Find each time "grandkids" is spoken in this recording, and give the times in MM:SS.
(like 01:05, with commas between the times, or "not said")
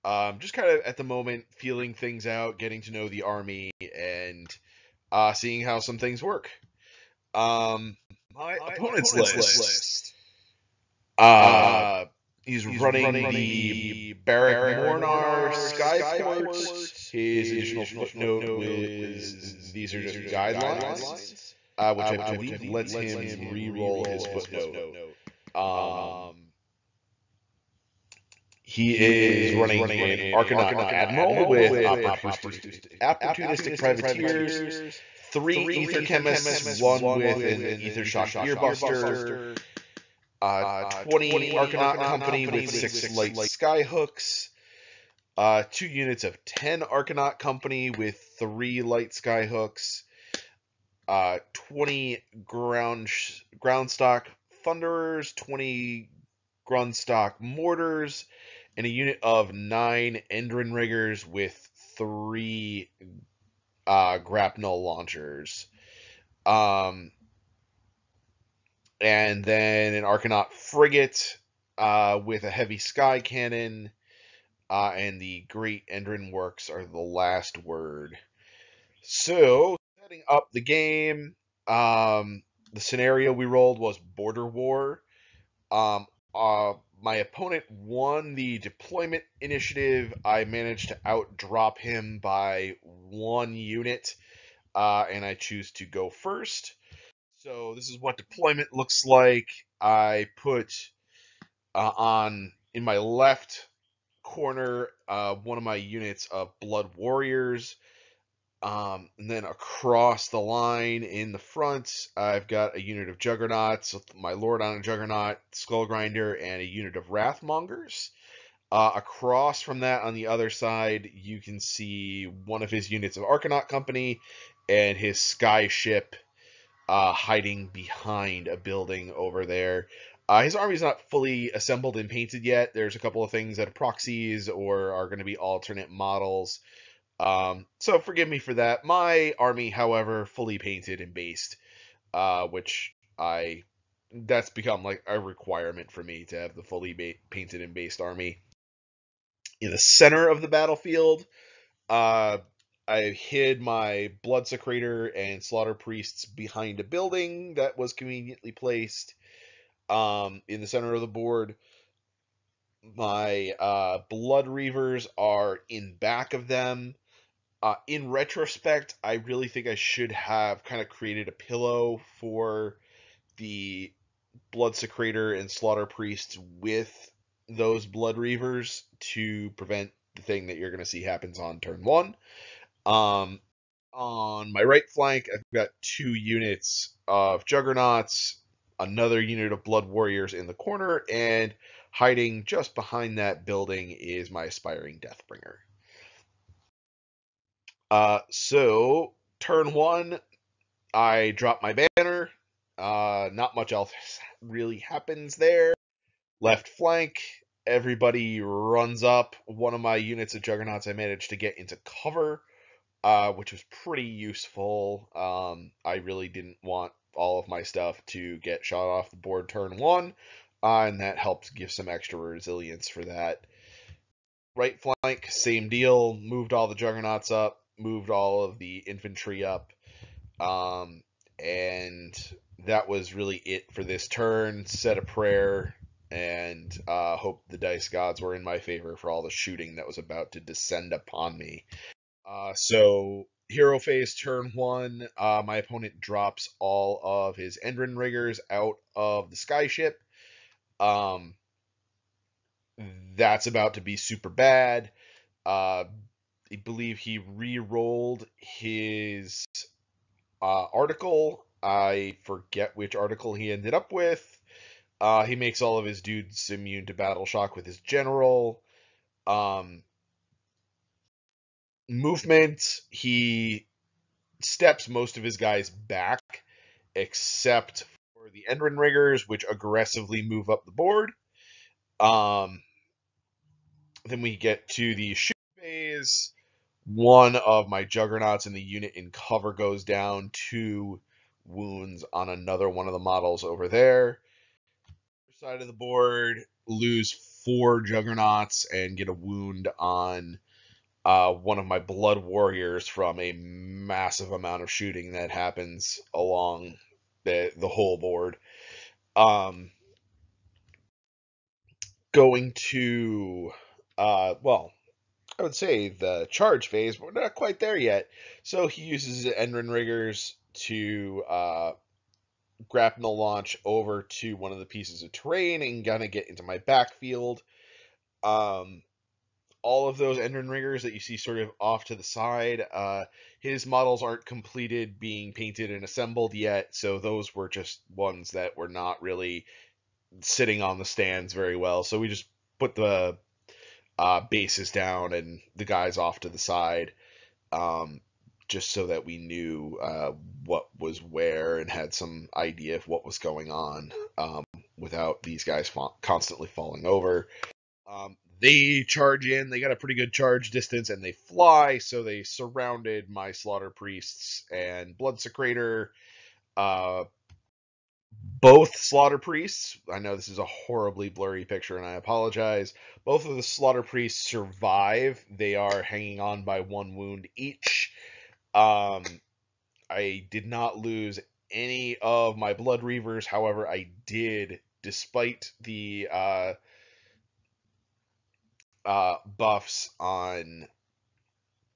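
not said.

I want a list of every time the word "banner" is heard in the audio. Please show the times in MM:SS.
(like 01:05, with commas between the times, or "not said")
03:21.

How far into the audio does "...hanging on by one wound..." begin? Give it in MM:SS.
06:15.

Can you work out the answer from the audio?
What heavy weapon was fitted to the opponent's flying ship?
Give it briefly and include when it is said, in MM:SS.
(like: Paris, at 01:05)
heavy sky cannon, at 01:12.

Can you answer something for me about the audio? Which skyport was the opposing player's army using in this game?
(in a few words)
Barak-Mornar.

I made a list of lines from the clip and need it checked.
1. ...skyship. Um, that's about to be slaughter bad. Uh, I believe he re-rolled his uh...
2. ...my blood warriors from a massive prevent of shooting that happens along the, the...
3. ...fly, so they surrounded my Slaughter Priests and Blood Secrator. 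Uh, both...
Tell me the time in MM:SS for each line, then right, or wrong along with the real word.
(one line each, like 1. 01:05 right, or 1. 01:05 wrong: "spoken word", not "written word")
1. 04:09 wrong: "super", not "slaughter"
2. 05:01 wrong: "amount", not "prevent"
3. 06:01 right.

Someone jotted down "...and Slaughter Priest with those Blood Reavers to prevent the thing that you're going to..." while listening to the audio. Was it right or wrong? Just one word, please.
right.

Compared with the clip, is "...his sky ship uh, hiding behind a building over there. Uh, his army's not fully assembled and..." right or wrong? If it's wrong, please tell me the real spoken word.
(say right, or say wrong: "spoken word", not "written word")
right.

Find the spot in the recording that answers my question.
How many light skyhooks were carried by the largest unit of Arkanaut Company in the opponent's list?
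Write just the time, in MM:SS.
00:42.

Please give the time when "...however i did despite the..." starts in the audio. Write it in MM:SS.
06:23.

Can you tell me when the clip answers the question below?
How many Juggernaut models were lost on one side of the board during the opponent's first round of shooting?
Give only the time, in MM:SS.
04:57.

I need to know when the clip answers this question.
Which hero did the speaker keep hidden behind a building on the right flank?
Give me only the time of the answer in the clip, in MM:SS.
03:14.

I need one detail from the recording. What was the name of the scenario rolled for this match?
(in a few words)
Border War.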